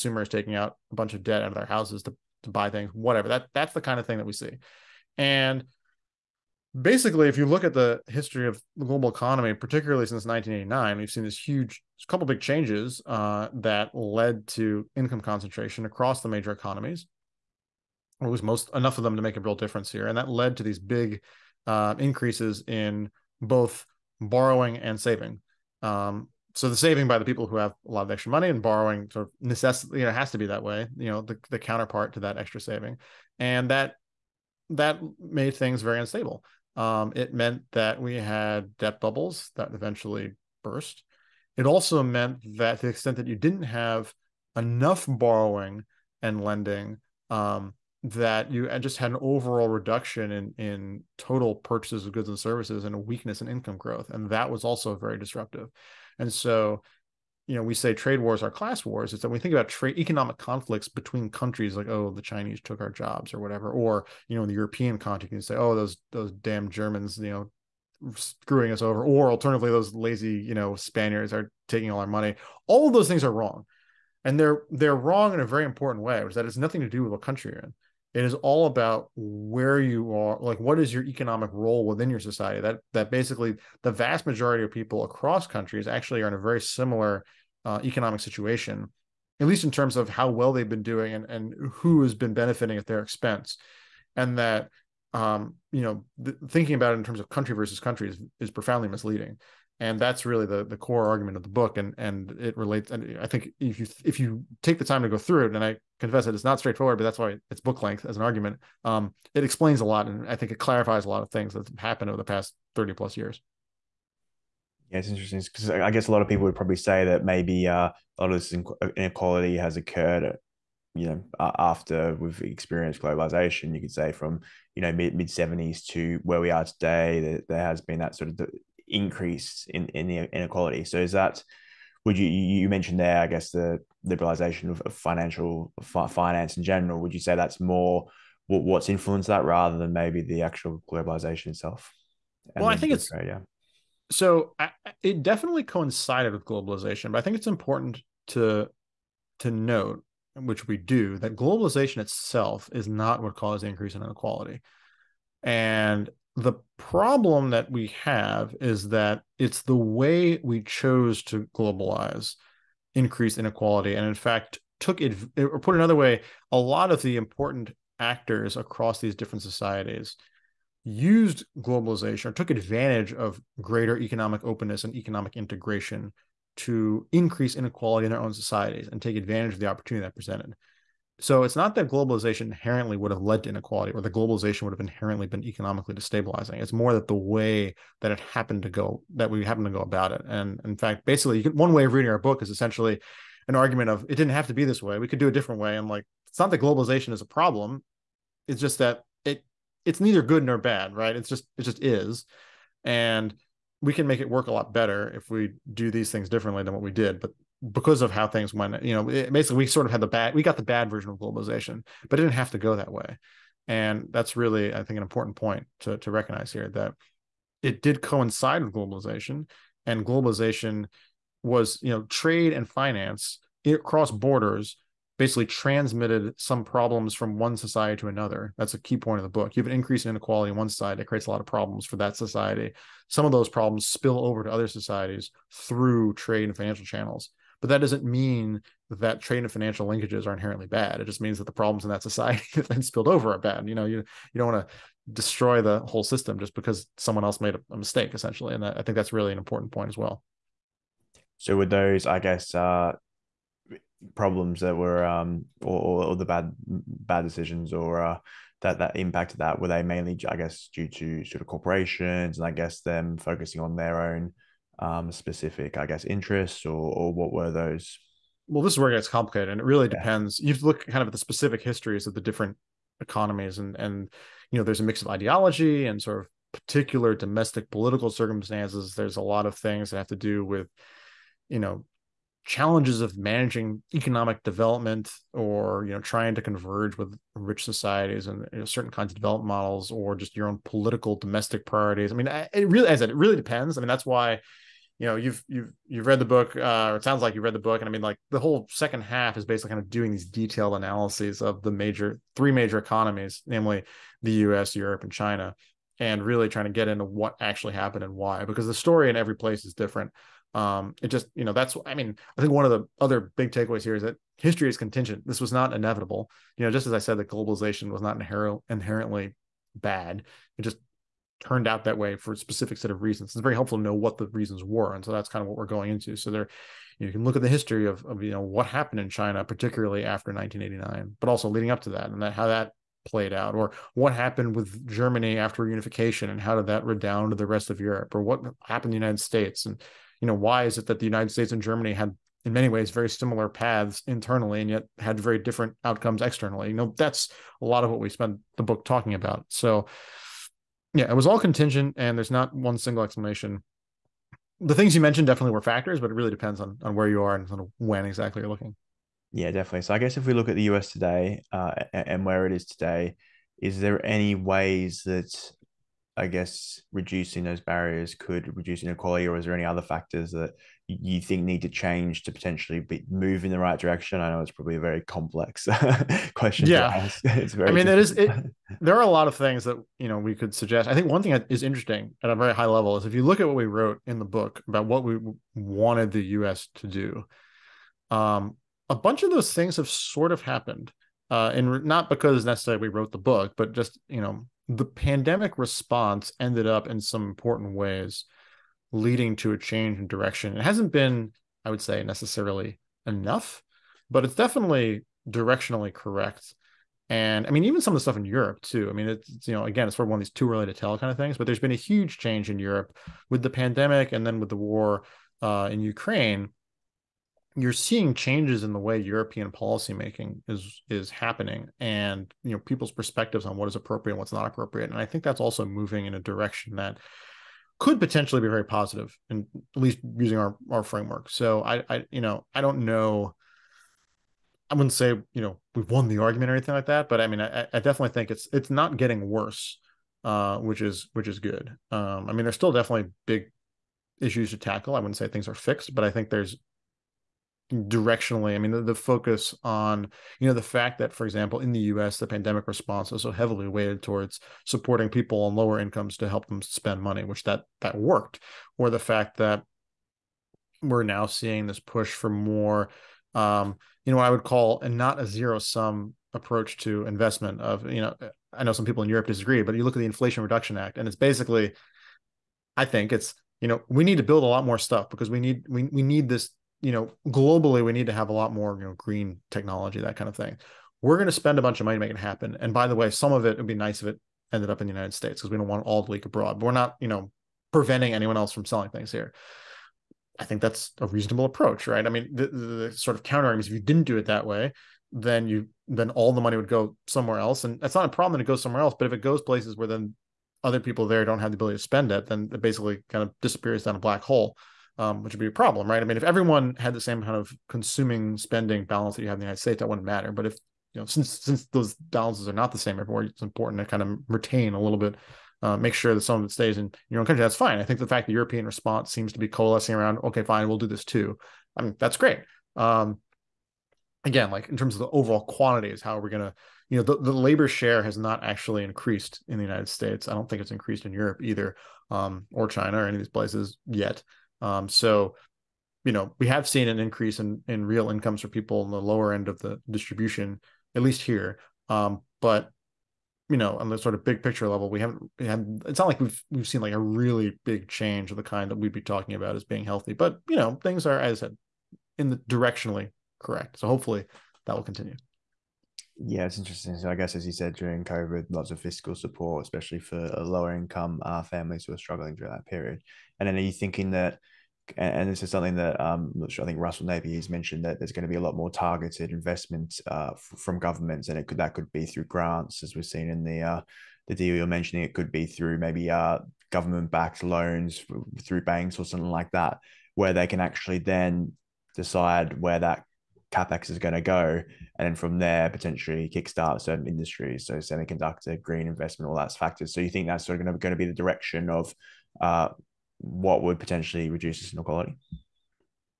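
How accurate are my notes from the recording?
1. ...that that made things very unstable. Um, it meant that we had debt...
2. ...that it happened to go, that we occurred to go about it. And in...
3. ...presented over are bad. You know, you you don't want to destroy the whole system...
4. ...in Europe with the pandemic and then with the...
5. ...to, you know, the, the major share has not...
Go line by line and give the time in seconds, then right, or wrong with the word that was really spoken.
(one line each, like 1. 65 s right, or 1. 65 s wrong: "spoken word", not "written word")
1. 33 s right
2. 188 s wrong: "happened", not "occurred"
3. 242 s wrong: "spilled", not "presented"
4. 412 s right
5. 526 s wrong: "labor", not "major".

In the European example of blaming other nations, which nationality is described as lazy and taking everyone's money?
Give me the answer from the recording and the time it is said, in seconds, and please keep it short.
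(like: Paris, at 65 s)
Spaniards, at 70 s.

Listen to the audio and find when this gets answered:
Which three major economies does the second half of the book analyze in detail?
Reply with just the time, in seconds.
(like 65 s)
304 s.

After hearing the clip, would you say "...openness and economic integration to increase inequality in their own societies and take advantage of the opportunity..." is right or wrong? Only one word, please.
right.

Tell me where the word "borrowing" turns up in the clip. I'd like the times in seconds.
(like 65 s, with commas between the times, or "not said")
24 s, 28 s, 45 s.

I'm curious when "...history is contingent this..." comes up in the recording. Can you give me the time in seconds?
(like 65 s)
314 s.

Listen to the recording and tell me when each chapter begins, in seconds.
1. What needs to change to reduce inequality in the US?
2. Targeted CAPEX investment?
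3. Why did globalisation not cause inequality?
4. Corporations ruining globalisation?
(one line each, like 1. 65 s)
1. 359 s
2. 554 s
3. 114 s
4. 239 s.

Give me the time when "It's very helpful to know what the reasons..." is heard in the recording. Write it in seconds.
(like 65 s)
323 s.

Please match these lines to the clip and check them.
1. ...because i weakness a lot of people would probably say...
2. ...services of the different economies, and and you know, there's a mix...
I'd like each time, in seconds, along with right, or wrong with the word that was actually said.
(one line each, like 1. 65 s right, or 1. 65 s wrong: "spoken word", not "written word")
1. 115 s wrong: "guess", not "weakness"
2. 271 s wrong: "histories", not "services".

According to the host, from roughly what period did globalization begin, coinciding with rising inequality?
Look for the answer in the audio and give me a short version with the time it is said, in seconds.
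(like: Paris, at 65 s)
mid 70s, at 124 s.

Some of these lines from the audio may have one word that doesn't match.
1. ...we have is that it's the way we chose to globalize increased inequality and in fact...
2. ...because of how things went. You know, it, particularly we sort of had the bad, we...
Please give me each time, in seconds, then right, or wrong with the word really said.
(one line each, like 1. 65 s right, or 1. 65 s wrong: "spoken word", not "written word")
1. 157 s right
2. 207 s wrong: "basically", not "particularly".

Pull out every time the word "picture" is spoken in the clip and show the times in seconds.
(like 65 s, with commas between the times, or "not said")
544 s.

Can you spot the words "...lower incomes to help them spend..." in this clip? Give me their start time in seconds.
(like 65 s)
455 s.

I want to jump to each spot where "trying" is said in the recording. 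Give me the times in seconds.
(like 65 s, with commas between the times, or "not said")
285 s, 306 s.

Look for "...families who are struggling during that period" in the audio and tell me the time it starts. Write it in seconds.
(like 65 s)
561 s.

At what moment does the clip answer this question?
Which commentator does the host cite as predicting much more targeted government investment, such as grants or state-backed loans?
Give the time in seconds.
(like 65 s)
566 s.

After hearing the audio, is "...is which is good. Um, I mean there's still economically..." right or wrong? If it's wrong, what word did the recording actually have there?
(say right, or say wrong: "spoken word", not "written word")
wrong: "definitely", not "economically".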